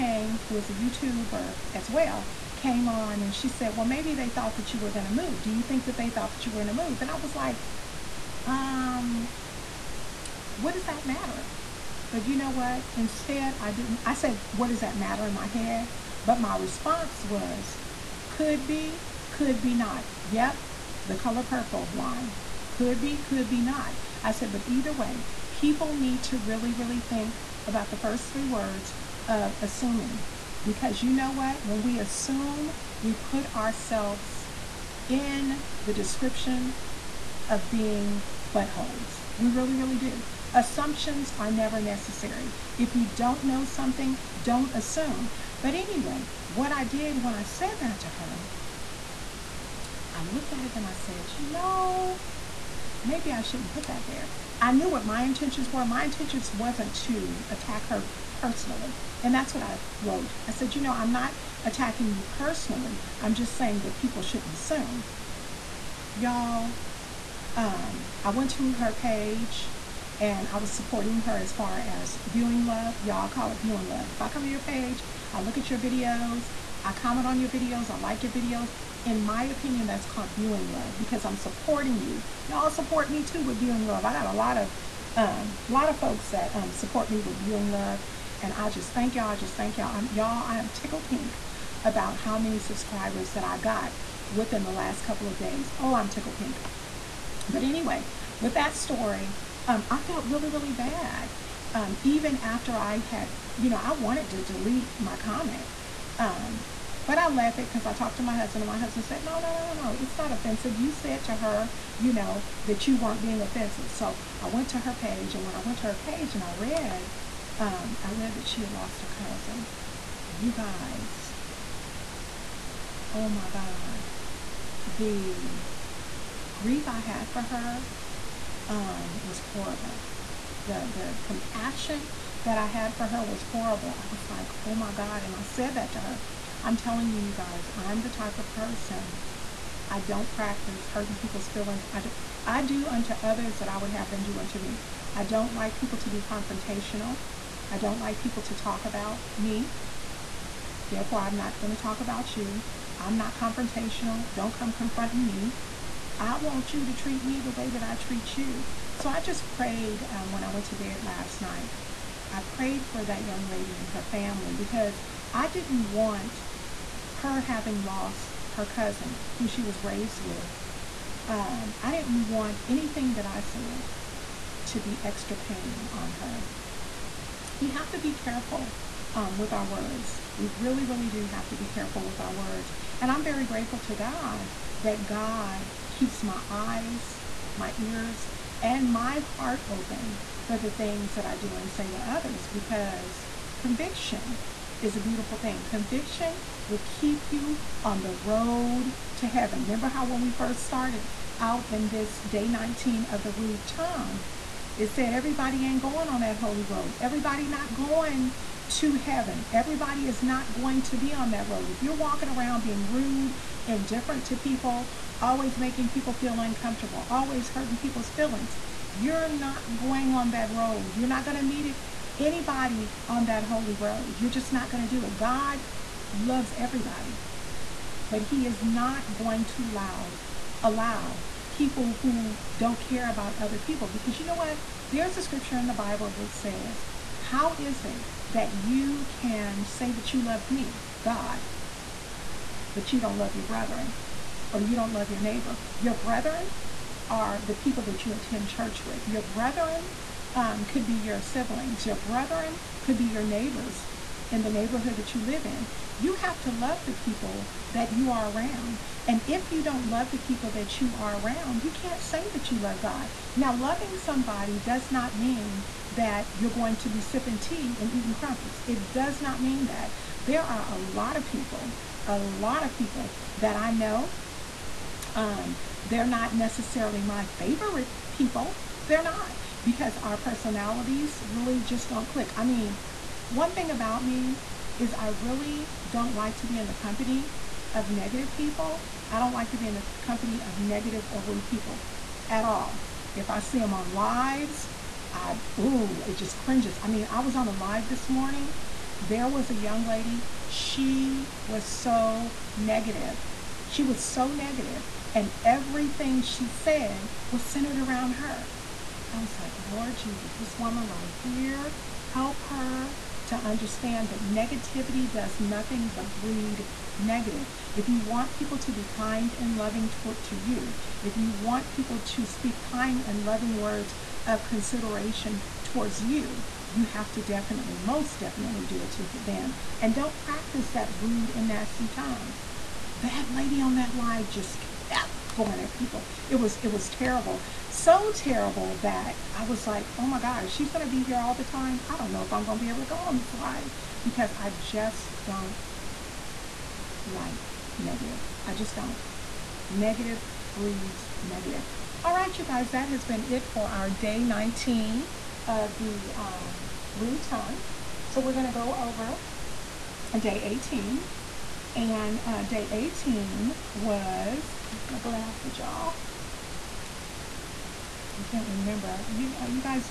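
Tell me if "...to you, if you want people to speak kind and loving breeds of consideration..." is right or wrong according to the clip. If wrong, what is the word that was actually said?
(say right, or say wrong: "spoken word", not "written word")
wrong: "words", not "breeds".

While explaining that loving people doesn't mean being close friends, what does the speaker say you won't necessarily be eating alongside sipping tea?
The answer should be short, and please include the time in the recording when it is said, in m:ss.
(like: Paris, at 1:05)
crumpets, at 4:28.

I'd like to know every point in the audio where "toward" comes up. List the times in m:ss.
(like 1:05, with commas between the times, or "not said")
5:19, 5:25.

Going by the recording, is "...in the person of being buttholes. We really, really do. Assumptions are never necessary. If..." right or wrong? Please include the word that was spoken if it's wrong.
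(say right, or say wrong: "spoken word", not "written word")
wrong: "description", not "person".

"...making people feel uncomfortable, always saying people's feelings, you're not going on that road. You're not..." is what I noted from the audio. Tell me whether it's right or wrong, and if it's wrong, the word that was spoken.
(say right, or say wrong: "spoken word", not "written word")
wrong: "hurting", not "saying".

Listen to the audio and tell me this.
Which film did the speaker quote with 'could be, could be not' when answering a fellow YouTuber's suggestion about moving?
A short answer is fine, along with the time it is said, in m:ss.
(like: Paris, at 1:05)
The Color Purple, at 0:21.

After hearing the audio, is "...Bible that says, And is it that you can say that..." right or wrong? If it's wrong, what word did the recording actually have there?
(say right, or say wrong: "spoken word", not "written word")
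wrong: "How", not "And".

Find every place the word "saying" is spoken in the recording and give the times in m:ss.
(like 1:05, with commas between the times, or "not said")
1:03.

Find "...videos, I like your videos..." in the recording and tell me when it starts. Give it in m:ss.
1:17.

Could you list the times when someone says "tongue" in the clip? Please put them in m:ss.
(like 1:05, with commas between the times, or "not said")
3:23, 5:31, 5:57.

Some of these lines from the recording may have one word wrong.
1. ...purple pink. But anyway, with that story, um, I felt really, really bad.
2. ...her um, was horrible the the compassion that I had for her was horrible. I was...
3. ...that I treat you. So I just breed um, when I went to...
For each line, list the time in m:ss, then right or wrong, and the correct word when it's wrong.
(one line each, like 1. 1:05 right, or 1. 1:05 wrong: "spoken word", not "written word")
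1. 1:36 wrong: "tickle", not "purple"
2. 2:07 right
3. 2:37 wrong: "prayed", not "breed".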